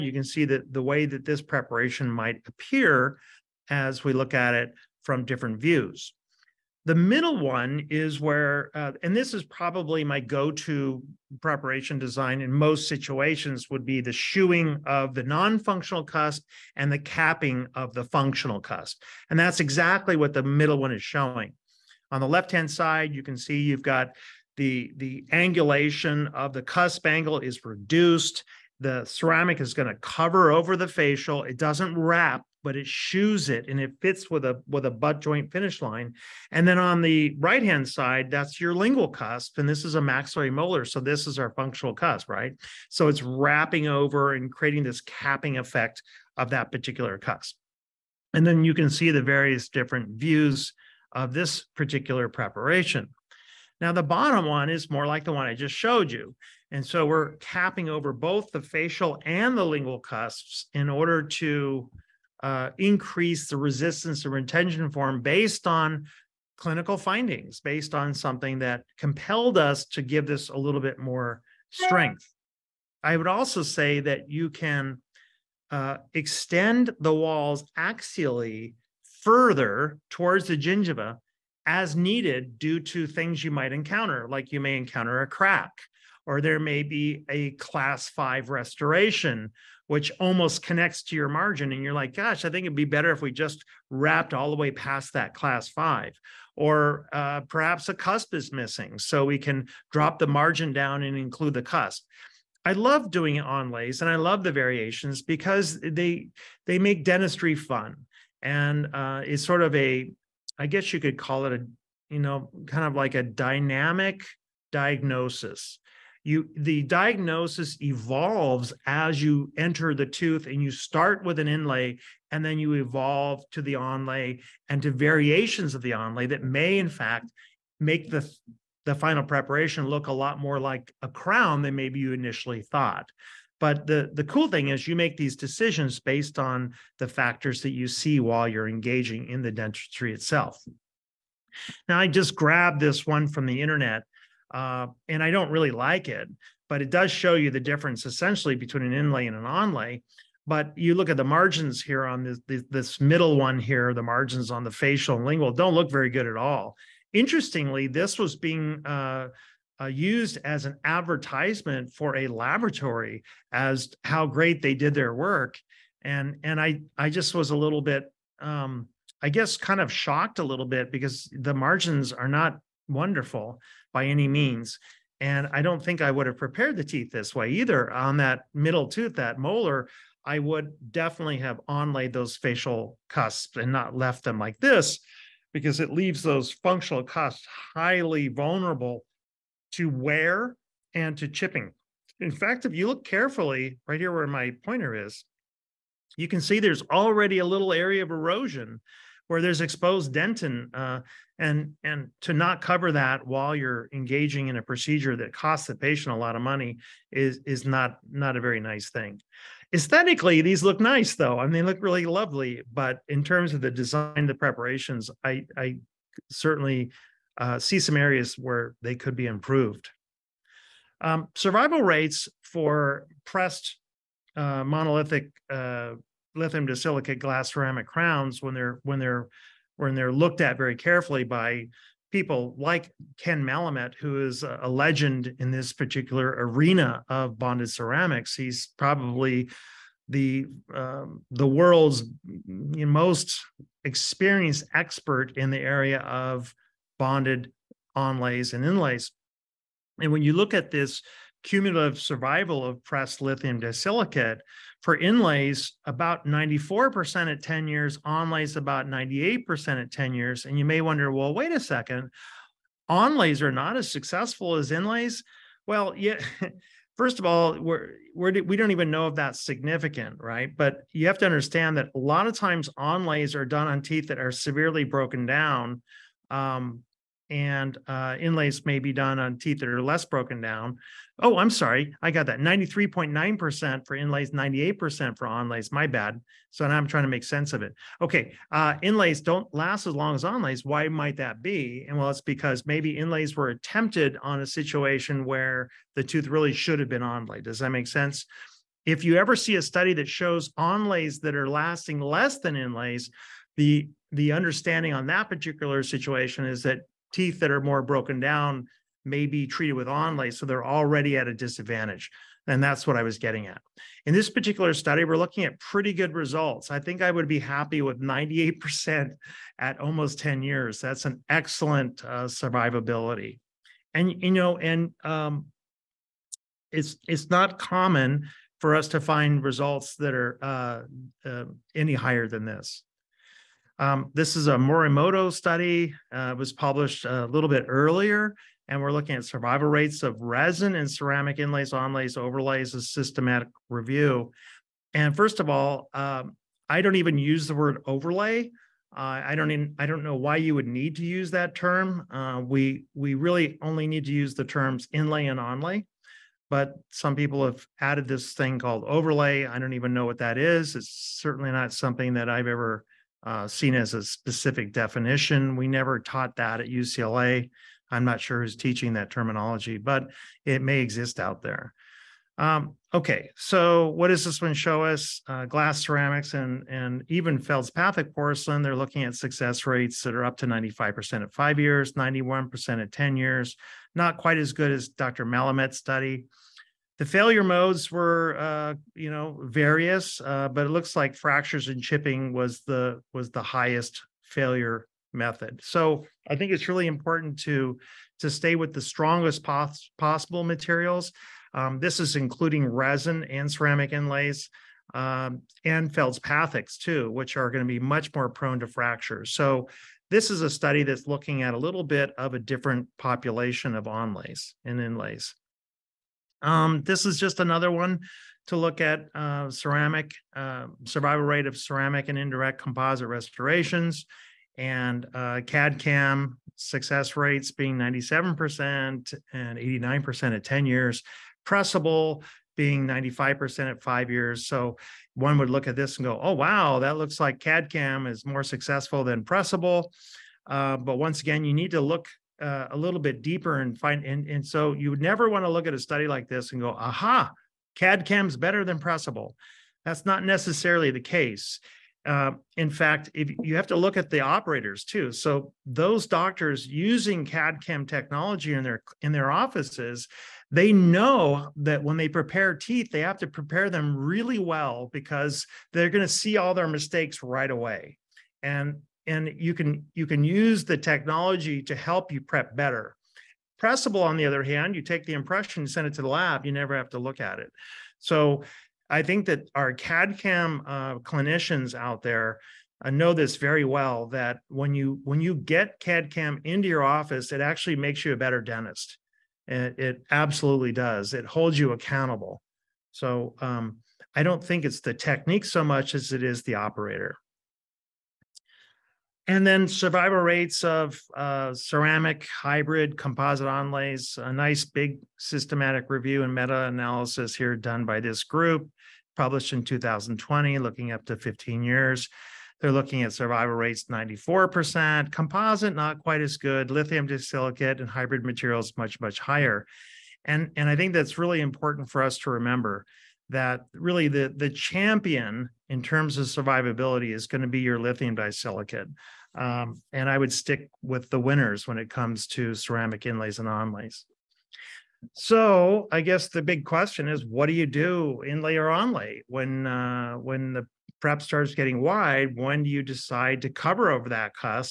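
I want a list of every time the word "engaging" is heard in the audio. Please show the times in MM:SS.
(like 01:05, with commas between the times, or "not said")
02:18, 03:23.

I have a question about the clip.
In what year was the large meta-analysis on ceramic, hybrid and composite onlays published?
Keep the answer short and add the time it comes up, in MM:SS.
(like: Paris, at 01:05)
2020, at 08:29.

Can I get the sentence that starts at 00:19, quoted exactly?
And that's exactly what the middle one is showing.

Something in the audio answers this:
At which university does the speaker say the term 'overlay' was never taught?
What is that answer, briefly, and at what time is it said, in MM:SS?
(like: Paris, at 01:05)
UCLA, at 06:06.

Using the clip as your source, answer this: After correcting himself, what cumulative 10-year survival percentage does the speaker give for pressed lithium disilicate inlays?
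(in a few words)
93.9%.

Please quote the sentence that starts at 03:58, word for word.
He's probably the um, the world's most experienced expert in the area of bonded onlays and inlays.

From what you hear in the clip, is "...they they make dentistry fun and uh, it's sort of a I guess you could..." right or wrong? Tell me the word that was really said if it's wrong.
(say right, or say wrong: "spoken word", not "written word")
right.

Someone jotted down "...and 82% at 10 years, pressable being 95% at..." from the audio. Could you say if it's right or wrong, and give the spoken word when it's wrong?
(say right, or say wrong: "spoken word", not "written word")
wrong: "89", not "82".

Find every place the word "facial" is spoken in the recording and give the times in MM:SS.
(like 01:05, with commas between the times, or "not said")
00:30, 00:58, 02:34, 03:02.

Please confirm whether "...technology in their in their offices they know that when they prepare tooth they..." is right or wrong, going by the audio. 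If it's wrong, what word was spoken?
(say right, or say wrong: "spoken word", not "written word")
wrong: "teeth", not "tooth".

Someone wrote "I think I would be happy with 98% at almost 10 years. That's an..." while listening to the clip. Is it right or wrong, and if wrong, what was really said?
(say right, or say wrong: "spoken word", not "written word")
right.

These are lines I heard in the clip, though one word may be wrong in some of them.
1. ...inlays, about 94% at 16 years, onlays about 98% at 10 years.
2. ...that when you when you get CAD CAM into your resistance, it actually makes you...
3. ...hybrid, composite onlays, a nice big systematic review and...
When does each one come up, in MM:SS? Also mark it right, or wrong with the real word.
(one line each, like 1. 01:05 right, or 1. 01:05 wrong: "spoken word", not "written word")
1. 04:14 wrong: "10", not "16"
2. 08:04 wrong: "office", not "resistance"
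3. 08:22 right.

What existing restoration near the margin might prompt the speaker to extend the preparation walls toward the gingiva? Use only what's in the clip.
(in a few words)
class five restoration.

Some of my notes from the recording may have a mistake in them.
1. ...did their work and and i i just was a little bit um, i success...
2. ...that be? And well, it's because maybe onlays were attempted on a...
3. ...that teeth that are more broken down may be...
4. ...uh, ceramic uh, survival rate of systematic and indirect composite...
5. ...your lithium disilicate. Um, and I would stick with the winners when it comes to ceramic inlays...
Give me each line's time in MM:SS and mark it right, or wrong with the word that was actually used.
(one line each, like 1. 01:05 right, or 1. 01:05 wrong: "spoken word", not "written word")
1. 02:44 wrong: "guess", not "success"
2. 04:51 wrong: "inlays", not "onlays"
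3. 05:06 right
4. 06:59 wrong: "ceramic", not "systematic"
5. 08:47 right.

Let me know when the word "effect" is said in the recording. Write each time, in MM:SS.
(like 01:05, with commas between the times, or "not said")
00:45.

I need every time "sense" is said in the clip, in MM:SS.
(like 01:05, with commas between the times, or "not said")
04:47, 04:57.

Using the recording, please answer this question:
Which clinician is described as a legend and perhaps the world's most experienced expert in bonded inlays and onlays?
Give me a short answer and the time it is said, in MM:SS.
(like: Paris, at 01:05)
Ken Malament, at 03:53.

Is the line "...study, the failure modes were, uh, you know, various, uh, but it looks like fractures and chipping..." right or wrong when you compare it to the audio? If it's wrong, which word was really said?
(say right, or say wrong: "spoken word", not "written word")
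right.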